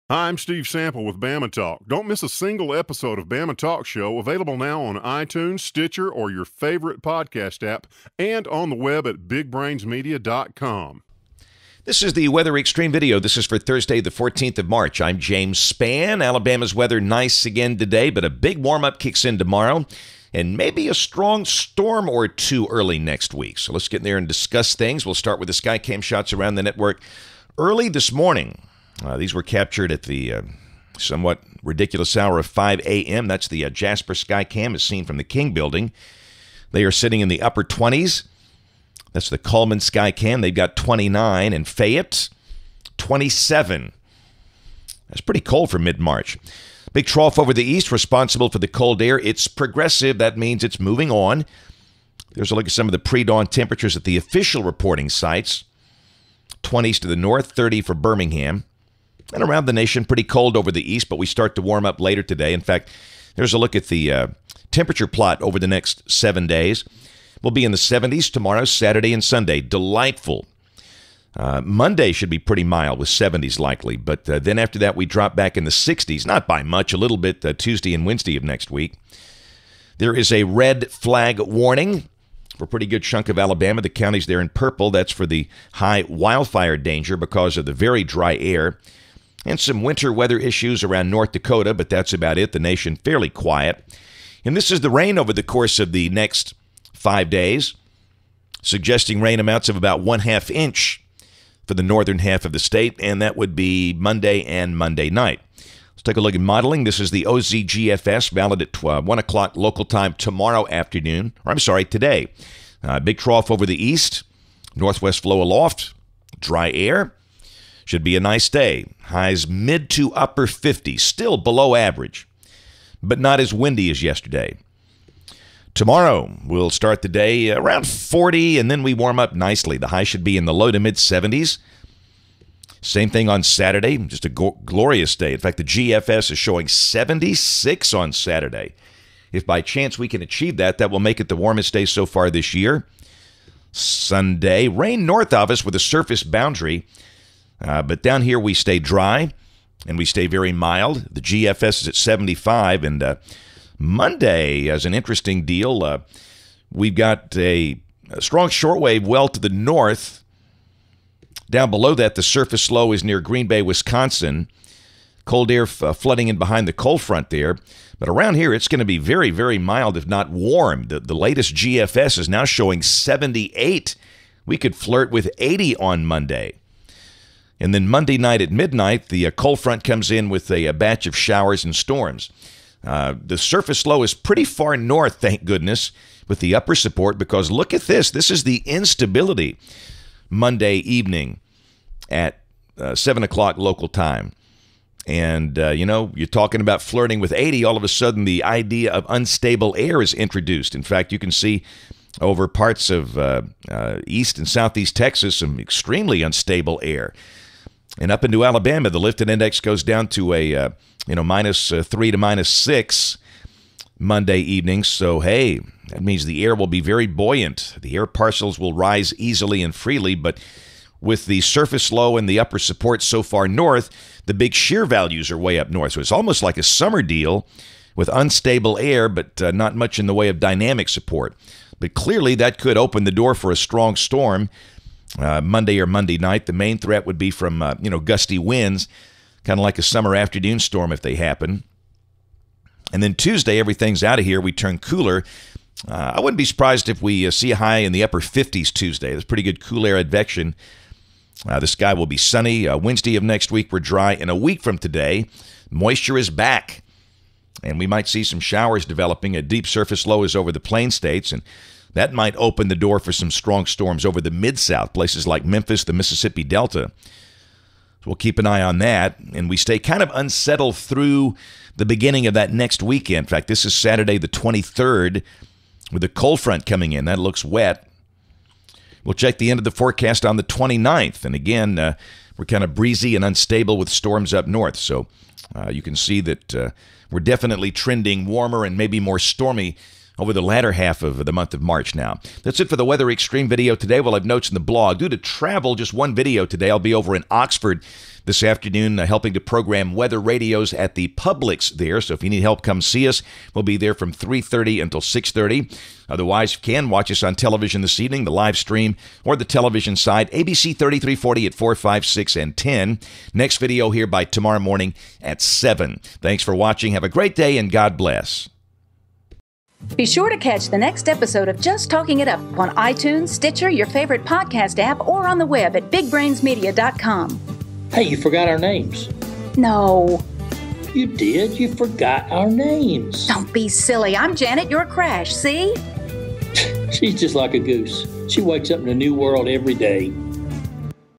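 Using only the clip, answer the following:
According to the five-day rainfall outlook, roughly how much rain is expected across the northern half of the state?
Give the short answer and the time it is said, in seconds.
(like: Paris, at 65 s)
one half inch, at 100 s.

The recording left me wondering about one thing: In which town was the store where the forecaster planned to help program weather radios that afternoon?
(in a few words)
Oxford.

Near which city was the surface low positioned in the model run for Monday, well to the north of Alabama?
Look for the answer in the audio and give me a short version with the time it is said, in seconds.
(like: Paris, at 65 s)
Green Bay, Wisconsin, at 163 s.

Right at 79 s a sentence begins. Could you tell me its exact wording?
There is a red flag warning for a pretty good chunk of Alabama.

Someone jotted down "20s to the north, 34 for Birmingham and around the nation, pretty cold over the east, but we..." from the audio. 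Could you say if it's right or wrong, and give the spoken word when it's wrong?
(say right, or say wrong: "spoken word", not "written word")
wrong: "30", not "34".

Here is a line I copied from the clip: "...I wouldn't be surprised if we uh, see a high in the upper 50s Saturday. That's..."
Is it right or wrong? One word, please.
wrong.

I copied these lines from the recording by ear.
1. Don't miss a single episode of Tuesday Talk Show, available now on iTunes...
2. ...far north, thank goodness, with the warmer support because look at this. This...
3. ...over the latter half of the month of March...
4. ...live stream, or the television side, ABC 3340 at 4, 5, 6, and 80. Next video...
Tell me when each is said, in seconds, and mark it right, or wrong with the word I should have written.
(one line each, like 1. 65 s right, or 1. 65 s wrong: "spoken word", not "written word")
1. 1 s wrong: "Bama", not "Tuesday"
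2. 184 s wrong: "upper", not "warmer"
3. 290 s right
4. 308 s wrong: "10", not "80".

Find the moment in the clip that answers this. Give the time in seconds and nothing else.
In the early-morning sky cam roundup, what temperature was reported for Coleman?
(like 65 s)
40 s.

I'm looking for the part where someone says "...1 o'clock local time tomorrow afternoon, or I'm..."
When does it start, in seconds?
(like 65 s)
109 s.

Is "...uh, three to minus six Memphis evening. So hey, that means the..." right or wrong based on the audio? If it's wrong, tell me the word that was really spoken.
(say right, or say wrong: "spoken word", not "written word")
wrong: "Monday", not "Memphis".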